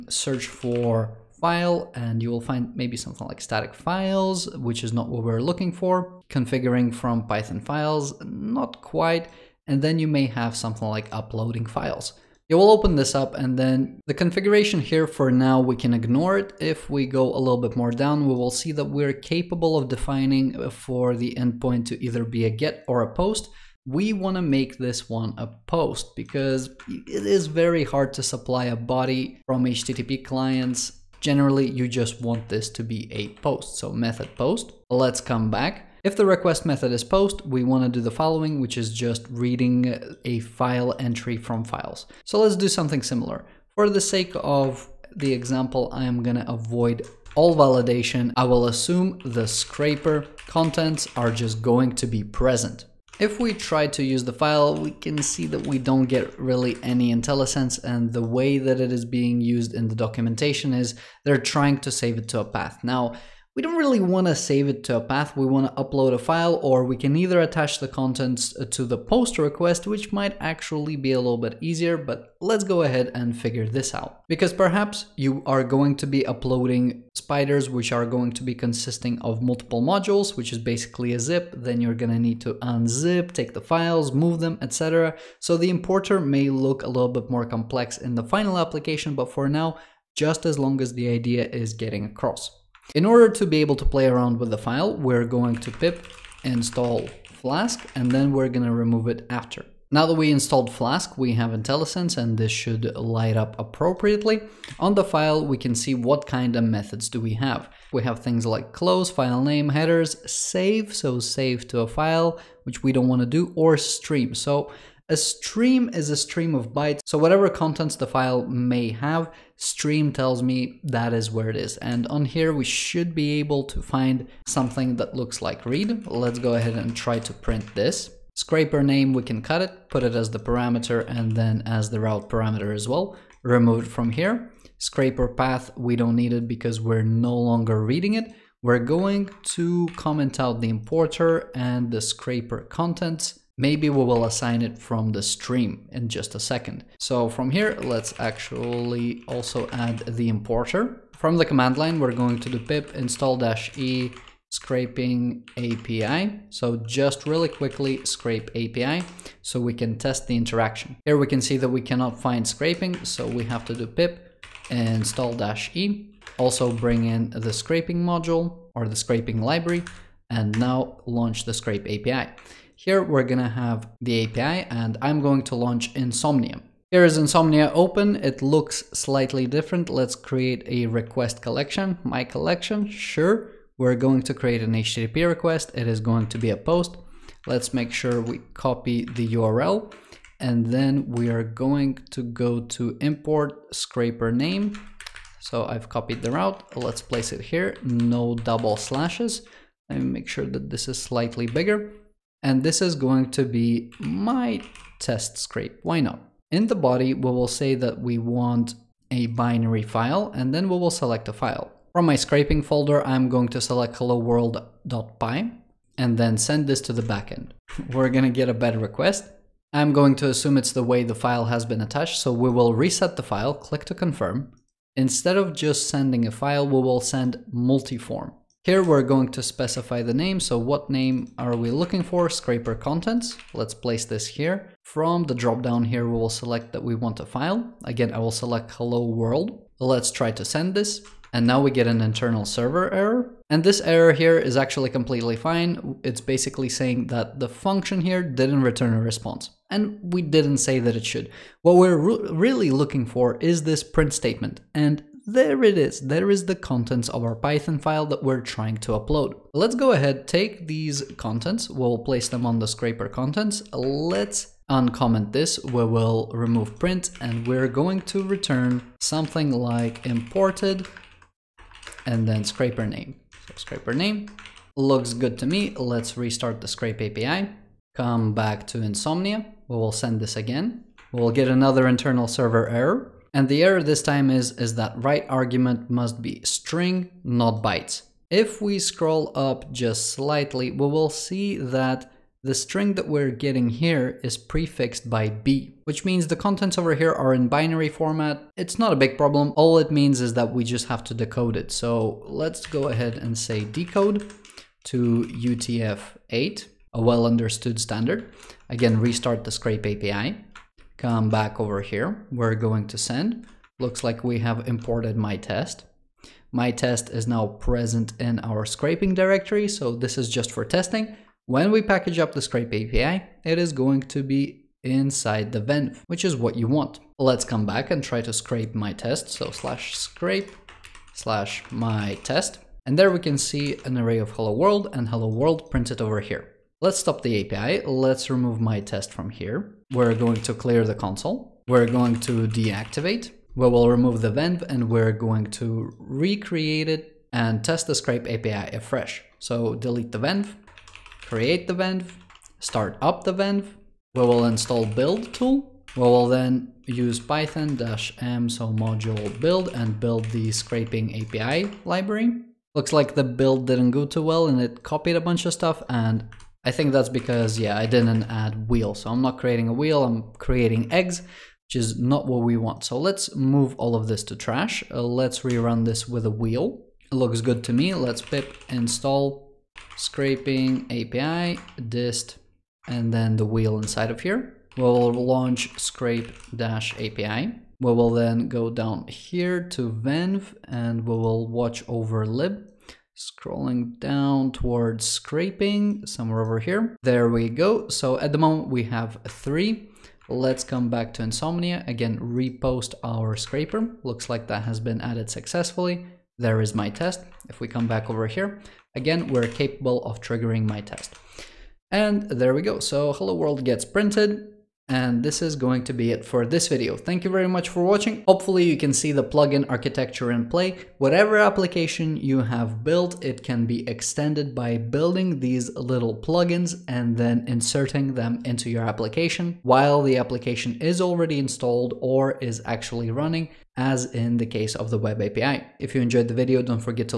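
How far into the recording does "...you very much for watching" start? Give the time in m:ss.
6:57.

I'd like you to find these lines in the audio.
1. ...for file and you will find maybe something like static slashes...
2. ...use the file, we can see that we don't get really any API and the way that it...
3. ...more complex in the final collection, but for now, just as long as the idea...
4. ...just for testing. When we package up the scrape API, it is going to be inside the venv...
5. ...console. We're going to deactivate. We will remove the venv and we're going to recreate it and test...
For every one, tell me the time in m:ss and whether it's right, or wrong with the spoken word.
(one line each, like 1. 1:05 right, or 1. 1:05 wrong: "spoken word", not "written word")
1. 0:00 wrong: "files", not "slashes"
2. 0:54 wrong: "IntelliSense", not "API"
3. 1:27 wrong: "application", not "collection"
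4. 5:20 right
5. 5:40 right.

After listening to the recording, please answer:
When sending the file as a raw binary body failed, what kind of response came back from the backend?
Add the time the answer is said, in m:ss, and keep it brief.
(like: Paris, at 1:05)
bad request, at 3:38.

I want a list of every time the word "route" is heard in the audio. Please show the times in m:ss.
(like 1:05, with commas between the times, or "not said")
2:12, 3:16.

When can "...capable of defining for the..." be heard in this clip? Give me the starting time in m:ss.
0:19.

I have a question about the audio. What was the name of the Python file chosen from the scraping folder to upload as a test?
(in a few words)
hello world.py.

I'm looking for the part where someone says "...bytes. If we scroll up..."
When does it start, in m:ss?
4:47.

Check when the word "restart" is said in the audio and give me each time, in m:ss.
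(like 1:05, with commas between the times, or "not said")
4:36, 5:08.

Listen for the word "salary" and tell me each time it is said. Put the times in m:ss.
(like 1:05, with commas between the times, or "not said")
not said.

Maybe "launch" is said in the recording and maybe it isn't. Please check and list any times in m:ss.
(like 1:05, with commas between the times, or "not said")
2:51, 2:55, 6:25.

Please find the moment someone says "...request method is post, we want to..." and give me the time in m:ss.
0:36.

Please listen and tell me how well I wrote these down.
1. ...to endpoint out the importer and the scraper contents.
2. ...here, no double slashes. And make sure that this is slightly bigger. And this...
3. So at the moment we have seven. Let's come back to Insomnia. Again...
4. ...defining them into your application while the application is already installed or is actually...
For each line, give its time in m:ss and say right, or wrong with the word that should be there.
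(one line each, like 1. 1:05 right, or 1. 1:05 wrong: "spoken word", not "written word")
1. 2:19 wrong: "comment", not "endpoint"
2. 3:17 right
3. 6:37 wrong: "three", not "seven"
4. 7:07 wrong: "inserting", not "defining".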